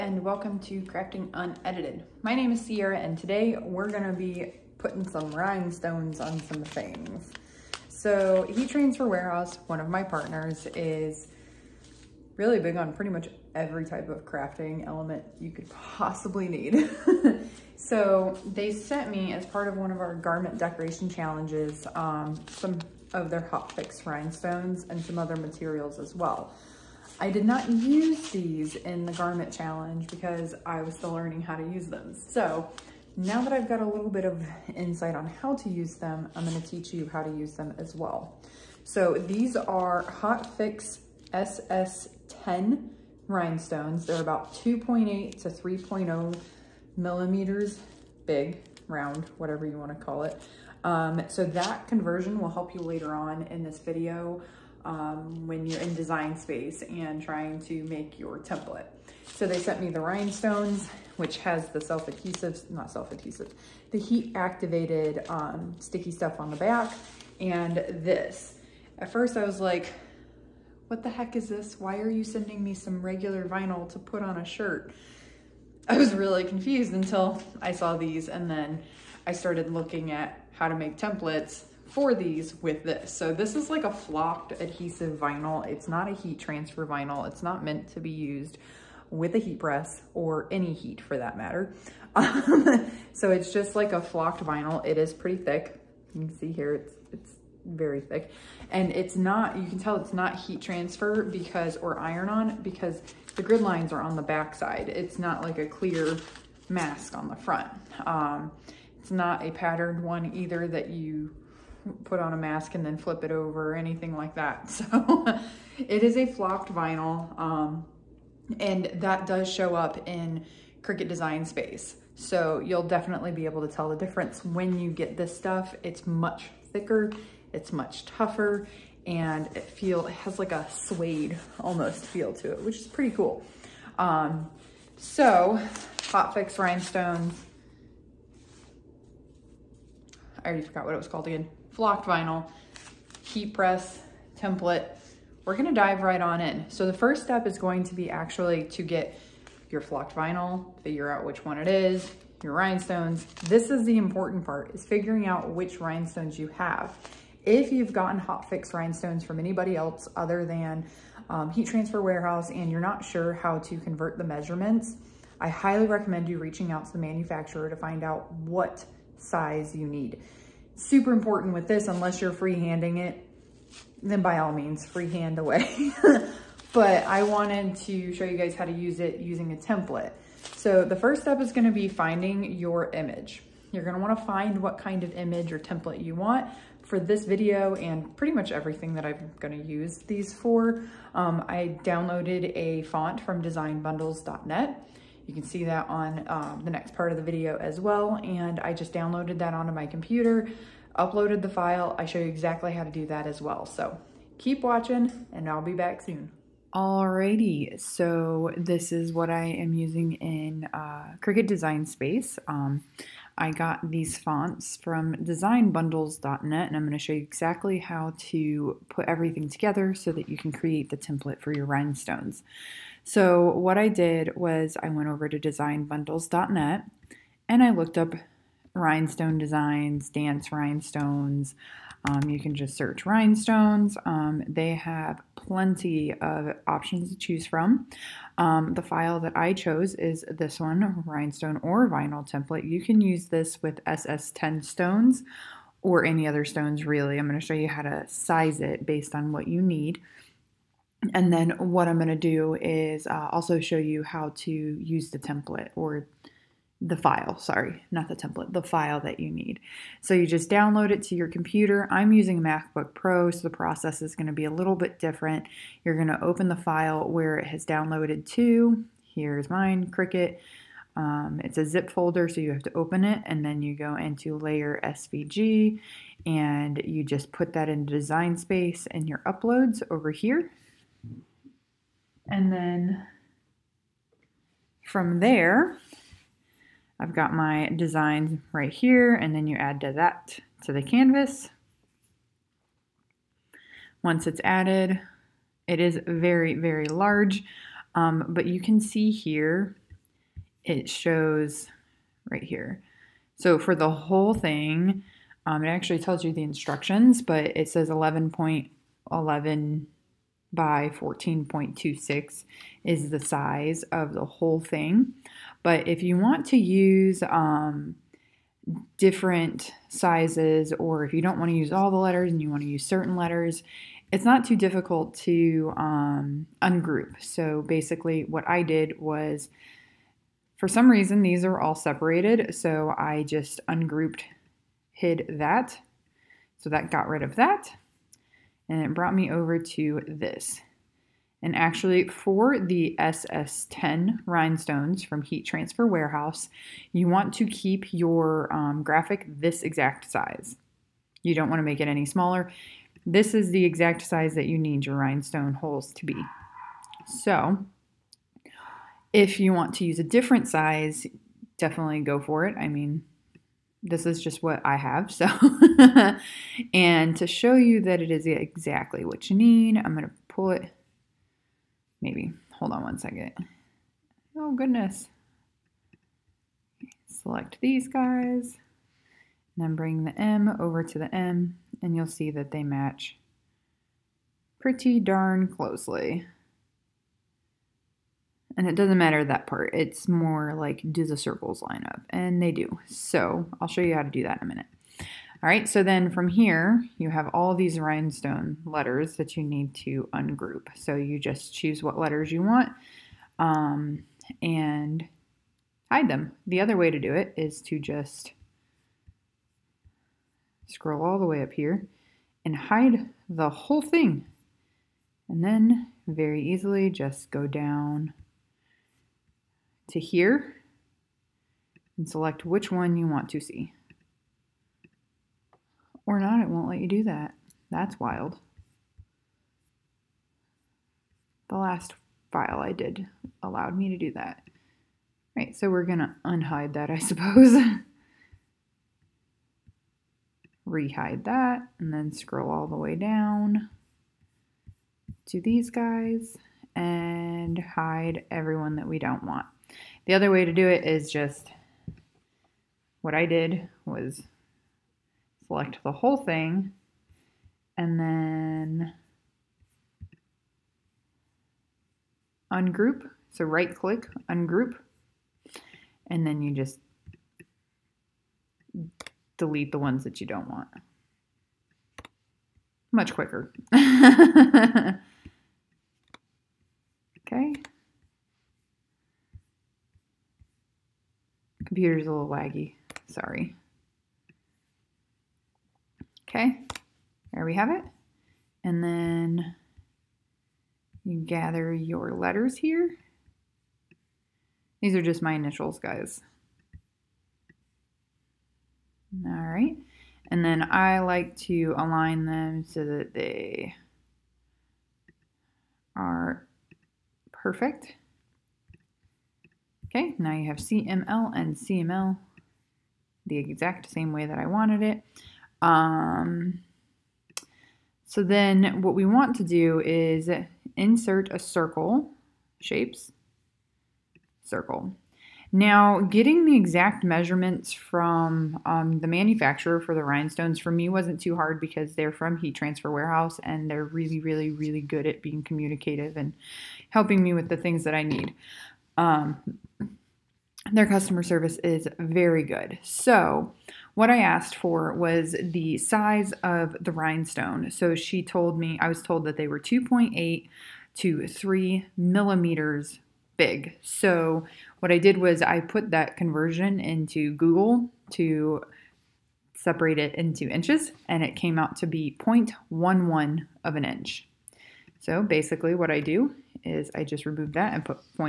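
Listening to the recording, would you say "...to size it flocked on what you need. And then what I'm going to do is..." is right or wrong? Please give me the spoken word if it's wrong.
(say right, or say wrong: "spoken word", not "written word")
wrong: "based", not "flocked".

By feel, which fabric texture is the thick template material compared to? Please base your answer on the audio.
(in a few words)
Suede.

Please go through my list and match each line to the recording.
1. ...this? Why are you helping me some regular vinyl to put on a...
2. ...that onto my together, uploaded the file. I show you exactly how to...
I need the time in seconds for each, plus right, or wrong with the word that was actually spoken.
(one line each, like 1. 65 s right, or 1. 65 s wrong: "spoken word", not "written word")
1. 71 s wrong: "sending", not "helping"
2. 199 s wrong: "computer", not "together".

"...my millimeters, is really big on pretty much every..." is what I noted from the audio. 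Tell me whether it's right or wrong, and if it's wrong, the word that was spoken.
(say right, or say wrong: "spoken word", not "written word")
wrong: "partners", not "millimeters".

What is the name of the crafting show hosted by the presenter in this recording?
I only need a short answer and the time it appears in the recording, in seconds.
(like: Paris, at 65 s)
Crafting Unedited, at 0 s.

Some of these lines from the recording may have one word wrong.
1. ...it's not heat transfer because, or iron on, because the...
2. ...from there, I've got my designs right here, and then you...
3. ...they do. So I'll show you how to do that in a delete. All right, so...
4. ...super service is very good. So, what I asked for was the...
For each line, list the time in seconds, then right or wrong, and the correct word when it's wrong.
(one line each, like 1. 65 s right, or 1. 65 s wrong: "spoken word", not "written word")
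1. 99 s right
2. 284 s right
3. 392 s wrong: "minute", not "delete"
4. 540 s wrong: "customer", not "super".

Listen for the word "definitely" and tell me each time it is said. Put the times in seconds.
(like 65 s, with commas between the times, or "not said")
122 s, 361 s.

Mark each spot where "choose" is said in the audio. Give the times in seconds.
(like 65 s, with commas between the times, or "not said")
237 s, 401 s.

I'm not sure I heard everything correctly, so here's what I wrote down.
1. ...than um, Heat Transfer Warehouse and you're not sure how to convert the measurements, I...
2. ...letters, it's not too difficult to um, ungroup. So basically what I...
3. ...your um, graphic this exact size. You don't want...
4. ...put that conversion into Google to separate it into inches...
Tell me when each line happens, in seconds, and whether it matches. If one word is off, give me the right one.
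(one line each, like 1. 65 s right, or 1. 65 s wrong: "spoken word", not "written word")
1. 160 s right
2. 323 s right
3. 347 s right
4. 555 s right.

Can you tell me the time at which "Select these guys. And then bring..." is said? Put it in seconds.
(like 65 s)
377 s.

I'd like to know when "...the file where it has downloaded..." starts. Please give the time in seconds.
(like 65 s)
266 s.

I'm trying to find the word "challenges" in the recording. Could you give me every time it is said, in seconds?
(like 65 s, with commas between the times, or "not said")
21 s, 29 s.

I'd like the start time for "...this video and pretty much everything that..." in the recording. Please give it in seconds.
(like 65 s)
186 s.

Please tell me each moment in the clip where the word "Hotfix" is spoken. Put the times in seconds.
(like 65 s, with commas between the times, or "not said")
40 s, 136 s.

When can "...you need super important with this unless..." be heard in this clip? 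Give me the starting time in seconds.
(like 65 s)
169 s.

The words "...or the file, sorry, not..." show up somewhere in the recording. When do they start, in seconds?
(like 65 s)
255 s.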